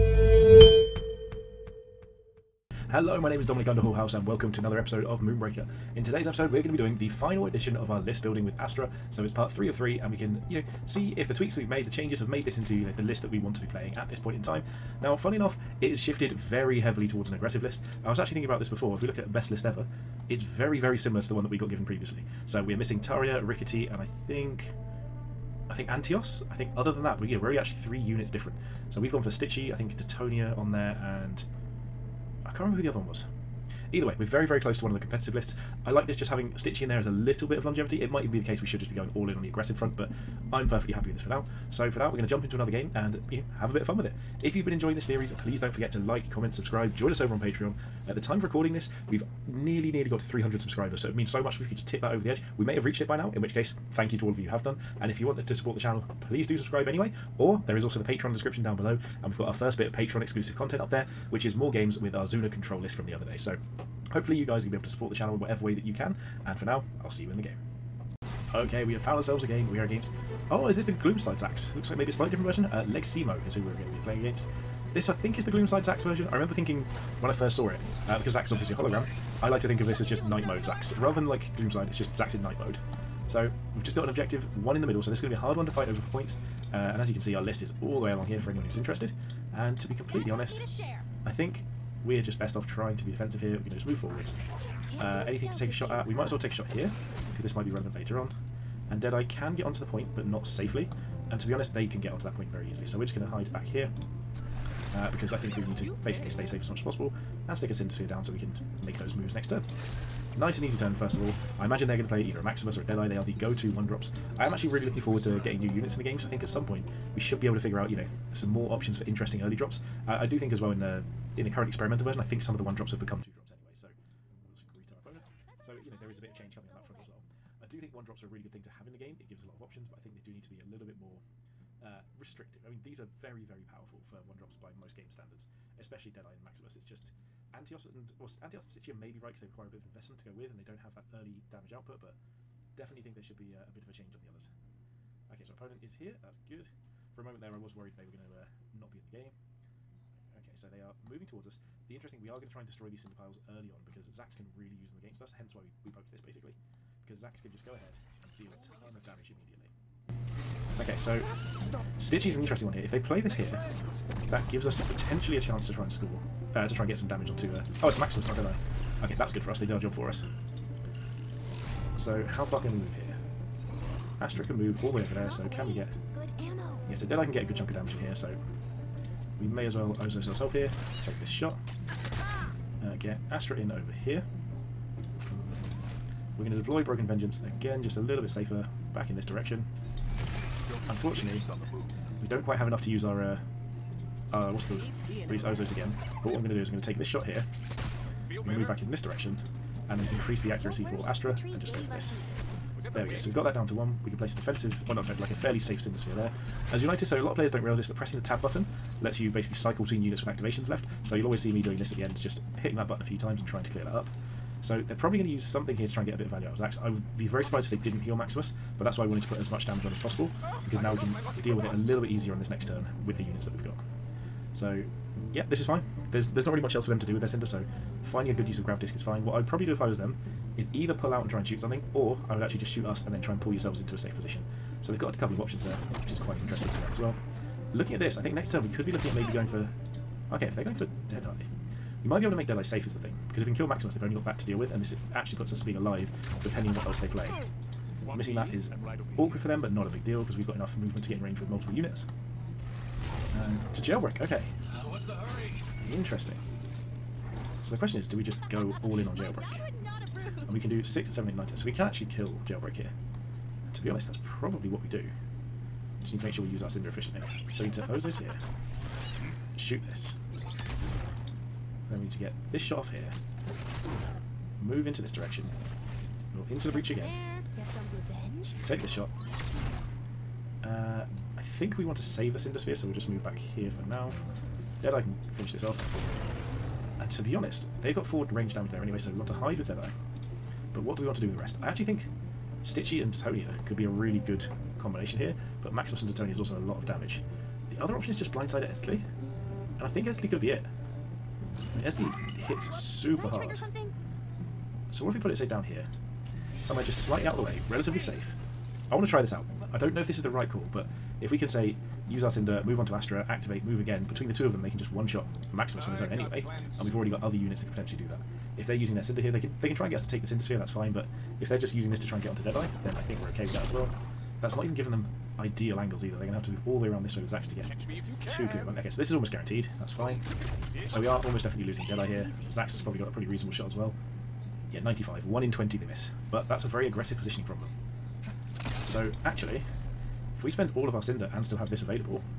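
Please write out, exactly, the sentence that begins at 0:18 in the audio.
I was actually thinking about this before.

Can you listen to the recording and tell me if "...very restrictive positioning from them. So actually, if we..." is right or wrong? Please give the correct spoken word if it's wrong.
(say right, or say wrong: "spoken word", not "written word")
wrong: "aggressive", not "restrictive".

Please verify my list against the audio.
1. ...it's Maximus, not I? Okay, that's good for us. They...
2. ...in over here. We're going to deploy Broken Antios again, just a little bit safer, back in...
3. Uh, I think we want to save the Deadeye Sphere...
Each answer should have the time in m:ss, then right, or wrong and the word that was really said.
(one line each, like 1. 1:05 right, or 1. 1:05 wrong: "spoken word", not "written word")
1. 2:47 right
2. 3:03 wrong: "Vengeance", not "Antios"
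3. 4:40 wrong: "Cinder", not "Deadeye".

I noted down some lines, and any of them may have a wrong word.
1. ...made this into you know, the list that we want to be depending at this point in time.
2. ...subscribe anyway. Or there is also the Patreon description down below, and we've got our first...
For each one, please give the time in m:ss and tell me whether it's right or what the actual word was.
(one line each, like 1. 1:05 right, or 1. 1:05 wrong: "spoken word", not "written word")
1. 0:12 wrong: "playing", not "depending"
2. 0:56 right.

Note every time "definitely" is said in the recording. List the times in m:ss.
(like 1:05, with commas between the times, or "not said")
2:22, 5:31.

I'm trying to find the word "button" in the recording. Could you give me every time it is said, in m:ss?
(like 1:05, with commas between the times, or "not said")
3:28, 3:32.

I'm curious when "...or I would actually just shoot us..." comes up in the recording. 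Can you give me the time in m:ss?
3:51.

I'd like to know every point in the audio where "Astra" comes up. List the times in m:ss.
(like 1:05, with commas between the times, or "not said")
0:08, 2:54, 3:03, 3:21, 5:12.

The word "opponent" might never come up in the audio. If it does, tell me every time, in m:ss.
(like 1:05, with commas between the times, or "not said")
2:04, 2:25.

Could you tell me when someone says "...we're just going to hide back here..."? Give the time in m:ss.
1:42.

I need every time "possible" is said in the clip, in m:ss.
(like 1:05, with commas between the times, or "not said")
1:46, 3:39.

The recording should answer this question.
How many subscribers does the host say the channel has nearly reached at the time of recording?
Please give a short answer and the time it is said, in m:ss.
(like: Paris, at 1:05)
300, at 0:50.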